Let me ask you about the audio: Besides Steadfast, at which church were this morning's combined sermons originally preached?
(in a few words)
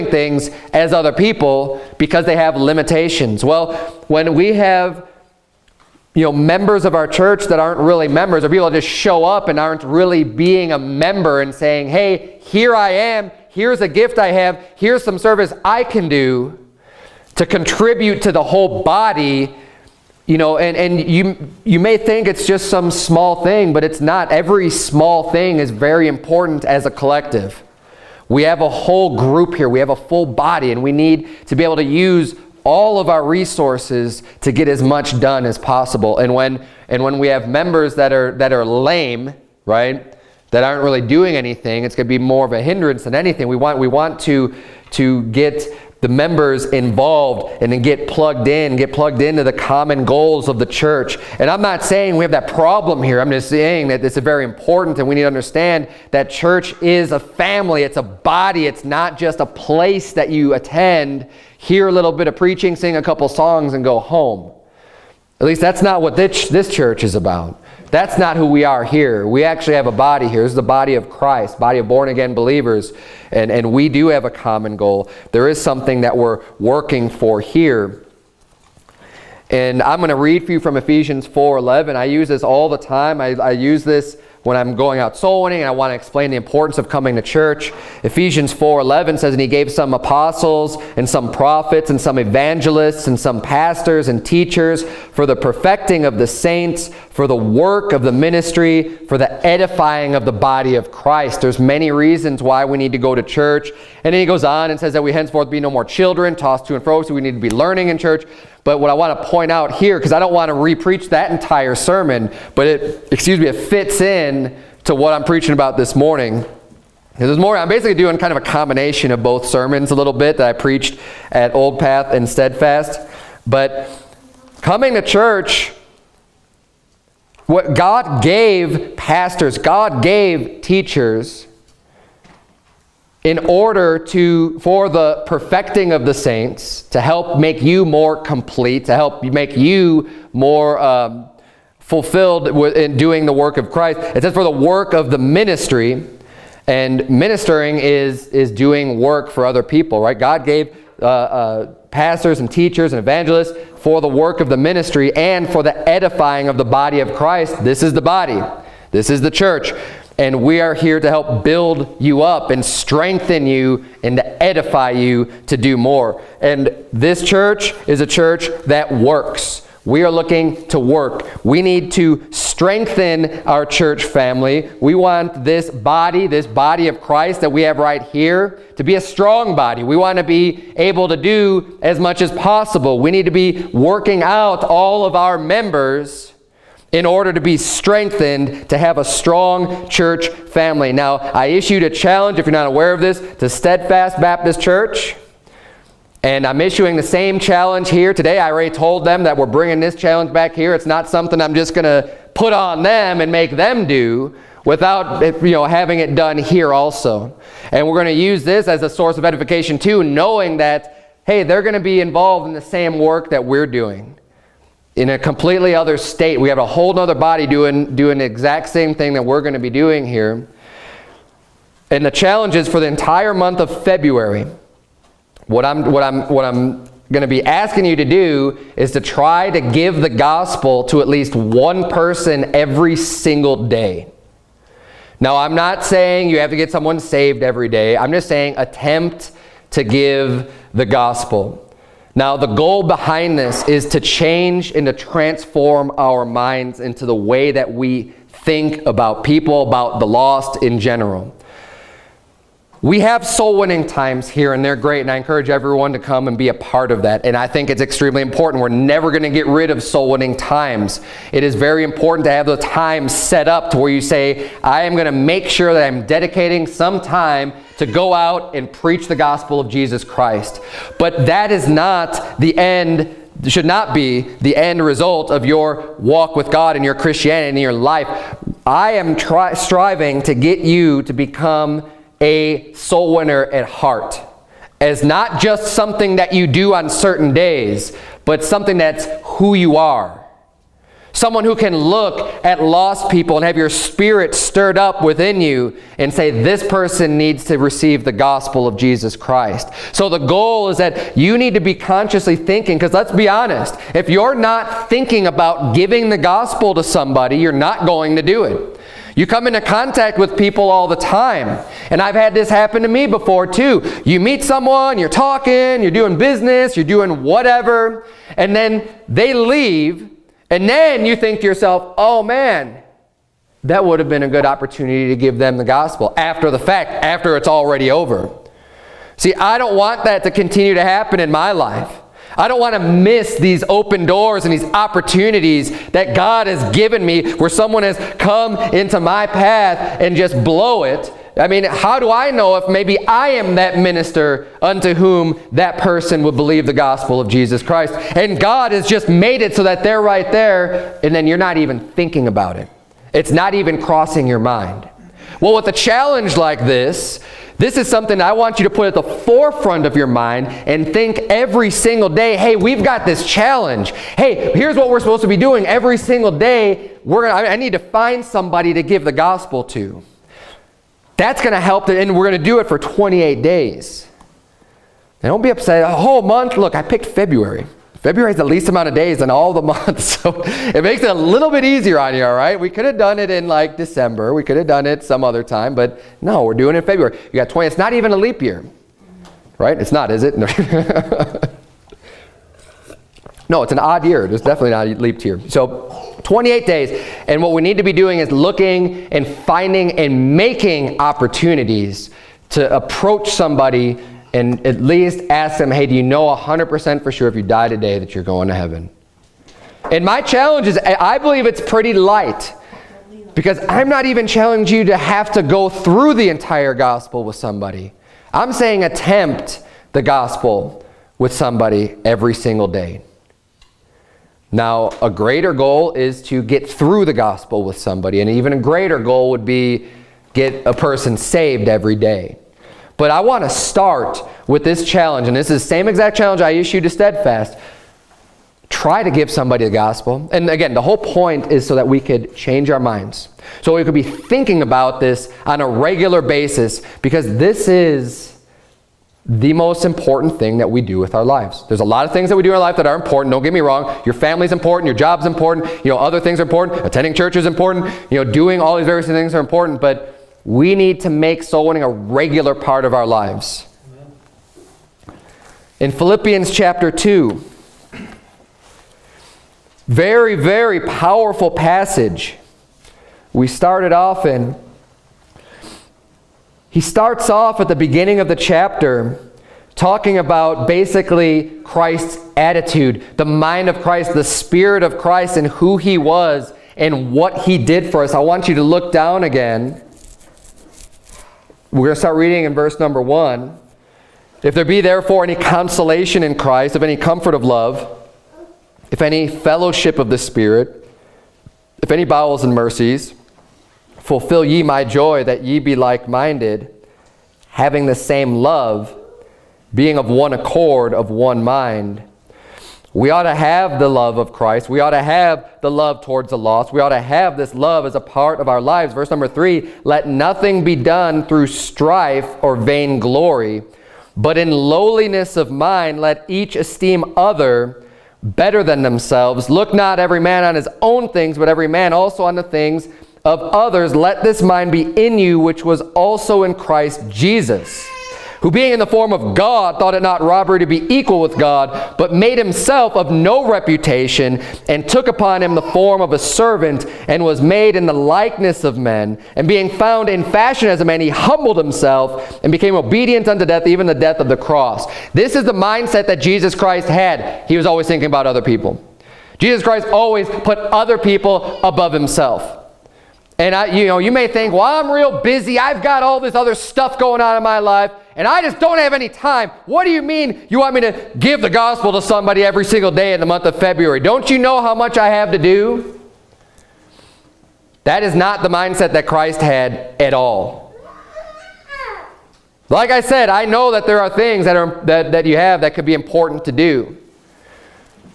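Old Path.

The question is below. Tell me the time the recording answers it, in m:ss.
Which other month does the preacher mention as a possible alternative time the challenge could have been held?
6:23.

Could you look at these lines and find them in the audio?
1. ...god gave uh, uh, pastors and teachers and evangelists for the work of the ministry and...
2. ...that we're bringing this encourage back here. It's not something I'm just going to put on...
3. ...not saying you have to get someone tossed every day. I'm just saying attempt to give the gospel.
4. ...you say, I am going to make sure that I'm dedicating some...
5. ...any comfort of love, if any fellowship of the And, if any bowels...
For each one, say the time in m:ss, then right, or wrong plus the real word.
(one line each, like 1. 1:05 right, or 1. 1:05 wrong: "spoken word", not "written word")
1. 2:30 right
2. 3:19 wrong: "challenge", not "encourage"
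3. 3:55 wrong: "saved", not "tossed"
4. 4:23 right
5. 8:16 wrong: "Spirit", not "And".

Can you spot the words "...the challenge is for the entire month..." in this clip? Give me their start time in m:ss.
3:42.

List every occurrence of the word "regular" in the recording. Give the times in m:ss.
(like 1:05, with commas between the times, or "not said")
7:25, 7:41.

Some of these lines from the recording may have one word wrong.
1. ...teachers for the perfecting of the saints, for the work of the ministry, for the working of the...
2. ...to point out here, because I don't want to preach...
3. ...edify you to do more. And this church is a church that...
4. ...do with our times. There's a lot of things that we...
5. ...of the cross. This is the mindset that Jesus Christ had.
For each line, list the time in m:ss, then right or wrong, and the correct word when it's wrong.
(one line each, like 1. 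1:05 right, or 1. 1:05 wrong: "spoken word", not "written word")
1. 1:34 wrong: "edifying", not "working"
2. 1:49 wrong: "repreach", not "preach"
3. 2:44 right
4. 7:30 wrong: "lives", not "times"
5. 9:14 right.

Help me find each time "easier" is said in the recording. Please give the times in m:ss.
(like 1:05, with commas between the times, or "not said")
6:21.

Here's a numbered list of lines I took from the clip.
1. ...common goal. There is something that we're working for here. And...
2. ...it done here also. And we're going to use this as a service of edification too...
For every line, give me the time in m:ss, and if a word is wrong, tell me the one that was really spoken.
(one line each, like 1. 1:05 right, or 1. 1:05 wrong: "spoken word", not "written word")
1. 1:14 right
2. 3:26 wrong: "source", not "service".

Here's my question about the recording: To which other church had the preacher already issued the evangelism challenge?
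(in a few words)
Steadfast Baptist Church.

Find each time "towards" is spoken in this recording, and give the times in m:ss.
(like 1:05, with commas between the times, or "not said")
8:36.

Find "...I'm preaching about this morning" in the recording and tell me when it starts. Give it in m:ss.
1:55.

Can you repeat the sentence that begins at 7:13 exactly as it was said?
But I want to start with this challenge, and this is the same exact challenge I issued to Steadfast.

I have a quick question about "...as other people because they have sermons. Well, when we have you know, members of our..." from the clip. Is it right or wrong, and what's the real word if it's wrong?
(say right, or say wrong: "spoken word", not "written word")
wrong: "limitations", not "sermons".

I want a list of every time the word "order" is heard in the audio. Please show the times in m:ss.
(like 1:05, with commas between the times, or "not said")
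2:13, 3:07.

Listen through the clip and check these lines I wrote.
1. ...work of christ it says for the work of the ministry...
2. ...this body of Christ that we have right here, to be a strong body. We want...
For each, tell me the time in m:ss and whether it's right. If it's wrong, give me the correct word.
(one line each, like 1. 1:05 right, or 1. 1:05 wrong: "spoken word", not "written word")
1. 2:23 right
2. 2:56 right.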